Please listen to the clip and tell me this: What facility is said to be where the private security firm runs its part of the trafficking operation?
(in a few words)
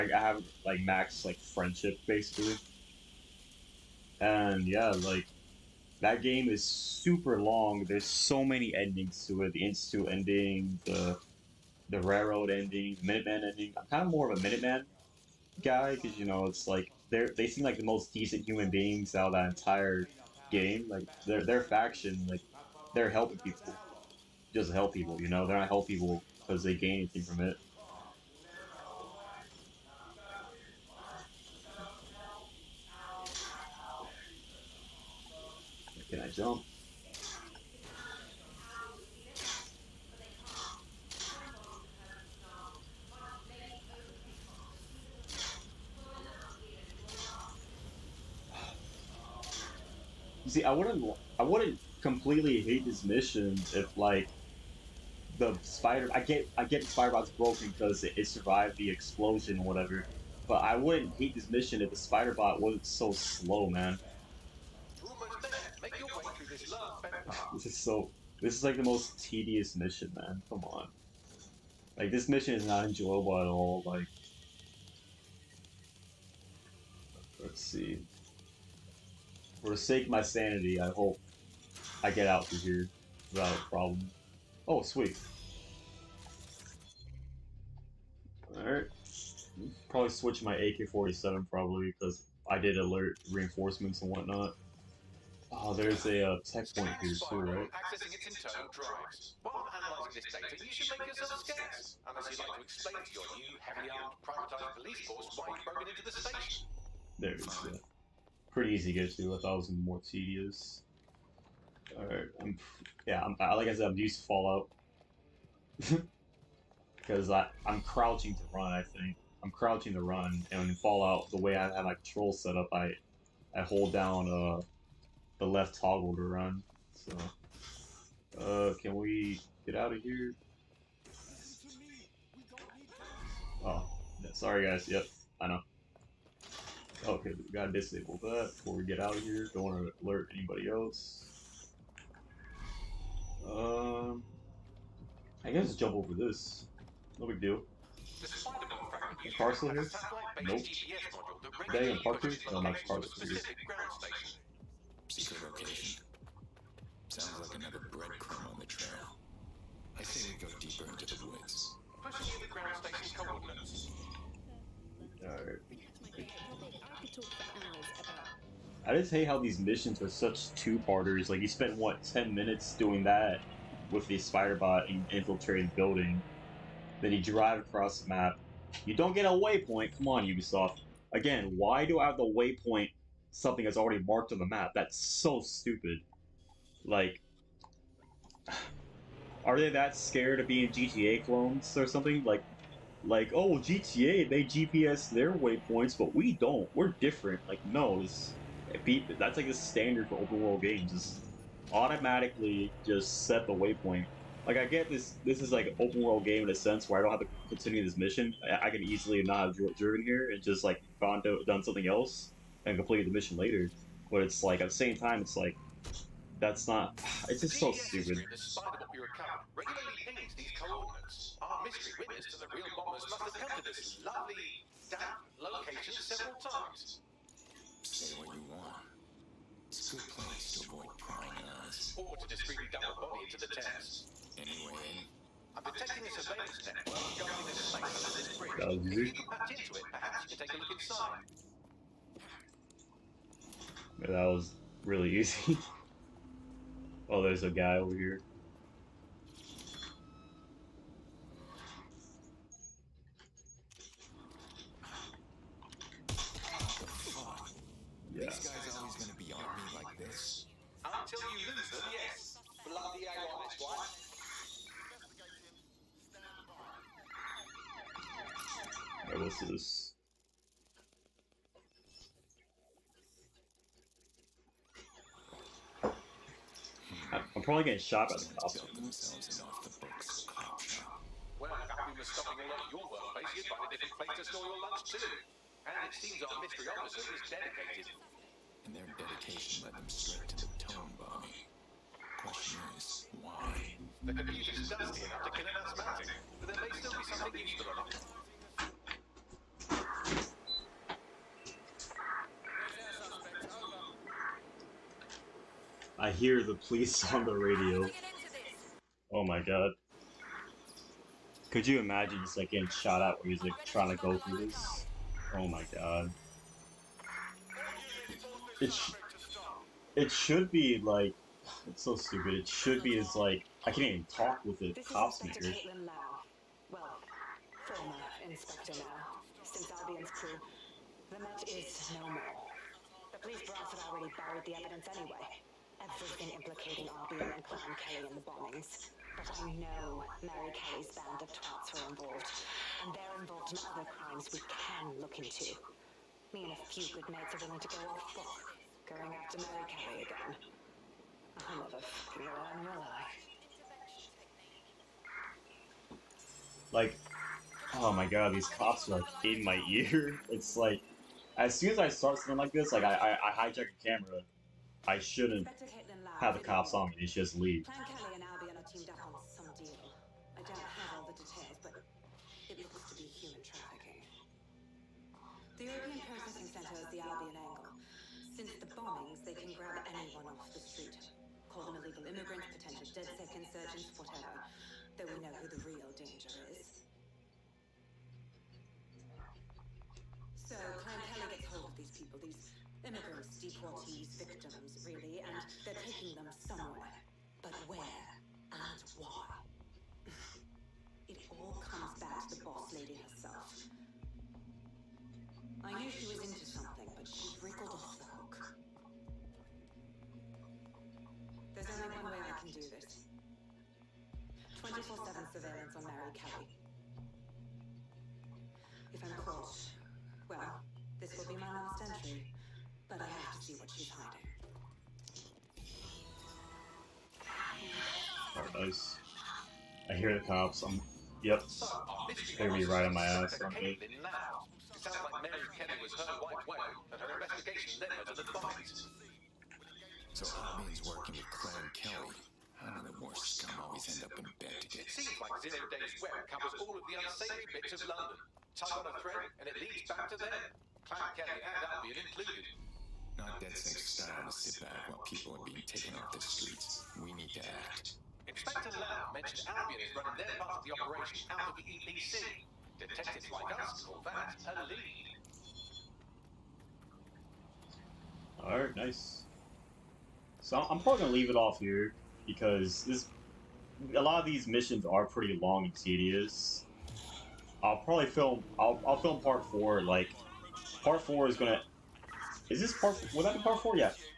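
European Processing Center.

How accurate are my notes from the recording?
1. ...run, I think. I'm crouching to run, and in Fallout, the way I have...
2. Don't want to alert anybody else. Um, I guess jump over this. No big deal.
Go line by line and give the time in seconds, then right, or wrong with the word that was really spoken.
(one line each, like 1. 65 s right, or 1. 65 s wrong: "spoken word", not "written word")
1. 118 s right
2. 139 s right.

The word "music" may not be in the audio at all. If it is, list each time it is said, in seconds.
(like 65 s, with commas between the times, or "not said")
313 s.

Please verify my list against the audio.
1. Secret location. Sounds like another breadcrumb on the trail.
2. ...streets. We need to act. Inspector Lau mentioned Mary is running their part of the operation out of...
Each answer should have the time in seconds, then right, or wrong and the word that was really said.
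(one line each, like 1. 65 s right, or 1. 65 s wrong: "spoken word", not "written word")
1. 155 s right
2. 456 s wrong: "Albion", not "Mary".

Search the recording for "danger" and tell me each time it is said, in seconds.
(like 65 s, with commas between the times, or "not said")
385 s.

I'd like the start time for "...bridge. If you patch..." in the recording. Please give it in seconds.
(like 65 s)
238 s.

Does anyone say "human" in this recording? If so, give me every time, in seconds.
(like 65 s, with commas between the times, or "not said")
18 s, 373 s.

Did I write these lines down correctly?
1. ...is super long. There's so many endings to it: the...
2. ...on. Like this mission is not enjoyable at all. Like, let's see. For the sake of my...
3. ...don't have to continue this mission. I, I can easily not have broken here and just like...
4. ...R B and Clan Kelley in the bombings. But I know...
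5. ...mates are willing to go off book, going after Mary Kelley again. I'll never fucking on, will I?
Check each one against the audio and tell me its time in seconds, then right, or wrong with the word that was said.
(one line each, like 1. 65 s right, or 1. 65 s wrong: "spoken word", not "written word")
1. 6 s right
2. 70 s right
3. 207 s wrong: "driven", not "broken"
4. 336 s right
5. 347 s right.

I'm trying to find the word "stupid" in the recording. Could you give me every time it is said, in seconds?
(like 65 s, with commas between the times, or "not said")
185 s, 217 s, 321 s.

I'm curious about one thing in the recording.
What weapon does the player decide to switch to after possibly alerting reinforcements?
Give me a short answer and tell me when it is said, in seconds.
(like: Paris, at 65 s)
AK-47, at 90 s.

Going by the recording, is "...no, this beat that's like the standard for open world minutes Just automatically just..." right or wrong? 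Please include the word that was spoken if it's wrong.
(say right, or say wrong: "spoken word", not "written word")
wrong: "games", not "minutes".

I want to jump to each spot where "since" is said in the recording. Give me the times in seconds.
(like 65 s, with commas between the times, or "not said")
329 s, 378 s.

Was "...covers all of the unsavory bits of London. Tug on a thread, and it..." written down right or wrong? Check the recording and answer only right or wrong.
right.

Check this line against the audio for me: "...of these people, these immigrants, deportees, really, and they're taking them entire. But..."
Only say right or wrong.
wrong.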